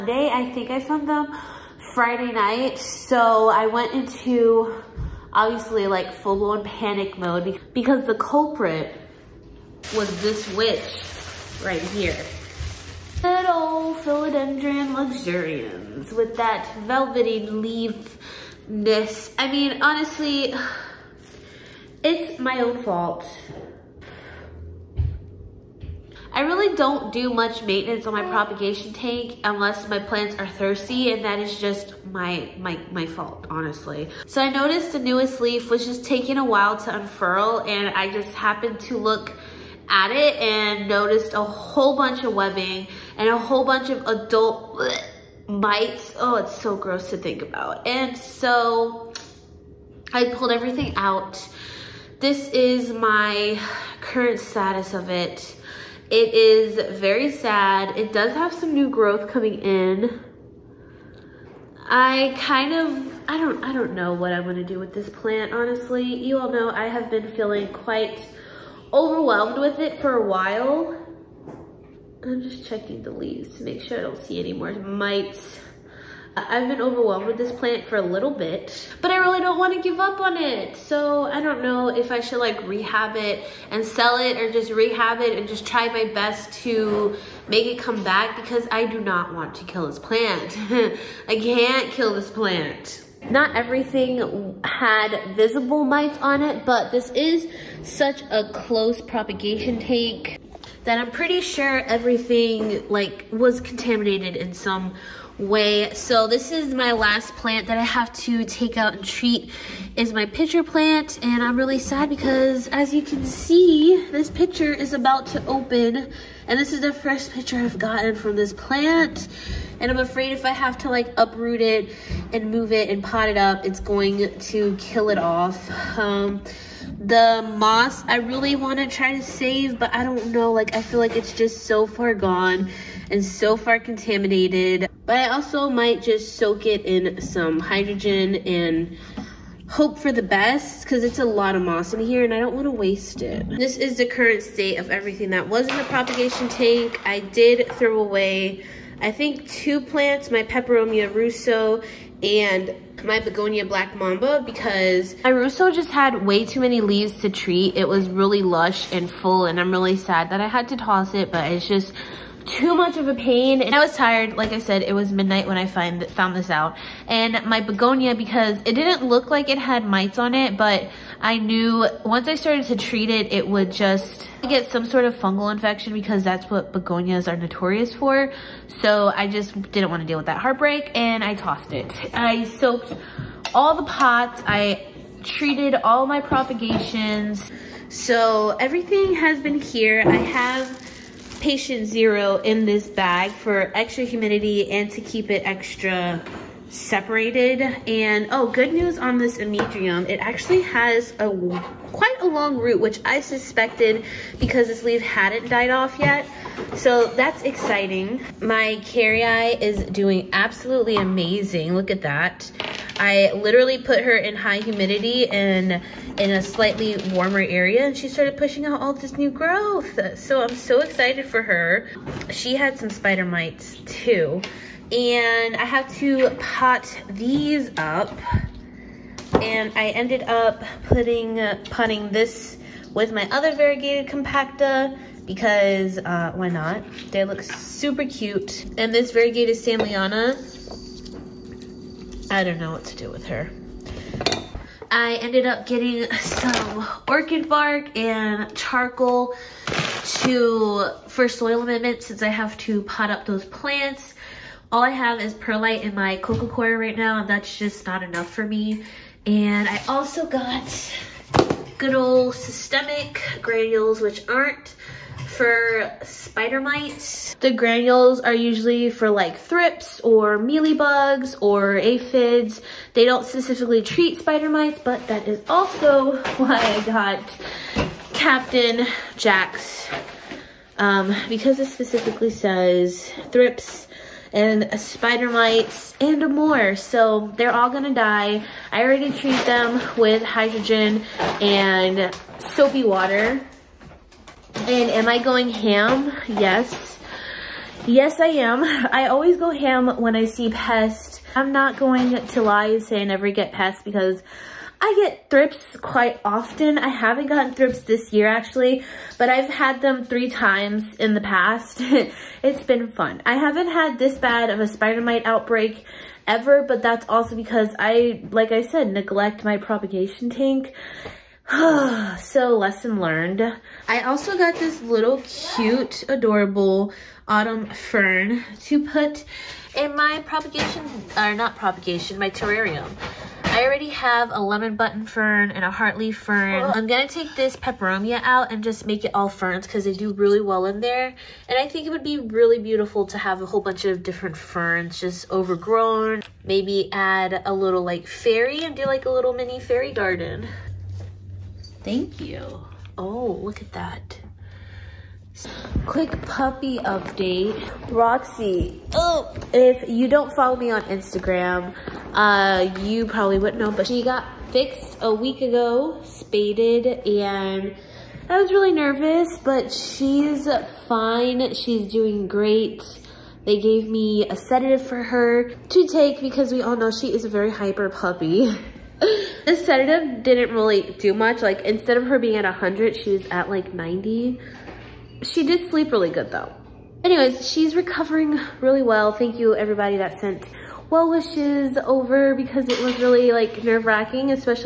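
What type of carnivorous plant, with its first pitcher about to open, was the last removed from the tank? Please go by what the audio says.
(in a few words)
pitcher plant.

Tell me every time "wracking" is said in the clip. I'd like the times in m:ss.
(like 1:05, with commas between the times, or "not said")
6:33.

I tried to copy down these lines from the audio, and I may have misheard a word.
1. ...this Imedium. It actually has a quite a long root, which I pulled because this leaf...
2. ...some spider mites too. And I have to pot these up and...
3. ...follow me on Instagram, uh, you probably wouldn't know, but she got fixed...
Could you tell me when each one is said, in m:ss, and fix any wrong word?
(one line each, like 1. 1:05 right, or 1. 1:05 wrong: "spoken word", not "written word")
1. 3:19 wrong: "suspected", not "pulled"
2. 3:42 right
3. 6:00 right.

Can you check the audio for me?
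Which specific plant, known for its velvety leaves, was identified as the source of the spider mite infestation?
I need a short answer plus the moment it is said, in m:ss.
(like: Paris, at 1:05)
philodendron luxurians, at 0:13.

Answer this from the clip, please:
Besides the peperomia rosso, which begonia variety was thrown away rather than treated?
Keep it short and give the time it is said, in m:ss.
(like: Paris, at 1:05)
black mamba, at 2:33.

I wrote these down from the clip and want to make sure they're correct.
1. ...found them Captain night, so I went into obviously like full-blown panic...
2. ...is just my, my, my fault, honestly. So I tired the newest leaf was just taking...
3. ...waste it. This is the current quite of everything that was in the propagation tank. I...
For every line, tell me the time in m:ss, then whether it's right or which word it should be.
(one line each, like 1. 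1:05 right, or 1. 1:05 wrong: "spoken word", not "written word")
1. 0:00 wrong: "Friday", not "Captain"
2. 0:31 wrong: "noticed", not "tired"
3. 2:22 wrong: "state", not "quite".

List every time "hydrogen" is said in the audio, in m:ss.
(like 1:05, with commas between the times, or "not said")
2:17, 4:50.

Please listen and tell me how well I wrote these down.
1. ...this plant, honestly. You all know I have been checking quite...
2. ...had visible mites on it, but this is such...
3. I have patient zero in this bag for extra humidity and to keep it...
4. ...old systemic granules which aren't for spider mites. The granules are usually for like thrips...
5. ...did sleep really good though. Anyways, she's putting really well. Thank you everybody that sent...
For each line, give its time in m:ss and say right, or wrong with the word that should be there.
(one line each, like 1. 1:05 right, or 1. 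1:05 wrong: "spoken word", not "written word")
1. 1:04 wrong: "feeling", not "checking"
2. 1:34 right
3. 3:10 right
4. 4:21 right
5. 6:25 wrong: "recovering", not "putting".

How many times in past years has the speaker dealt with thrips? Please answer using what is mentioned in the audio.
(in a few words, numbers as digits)
3.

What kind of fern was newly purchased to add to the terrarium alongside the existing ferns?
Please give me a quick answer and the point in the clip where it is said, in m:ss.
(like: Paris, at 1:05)
autumn fern, at 5:27.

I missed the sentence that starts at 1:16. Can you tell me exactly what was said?
I've been overwhelmed with this plant for a little bit, but I really don't want to give up on it.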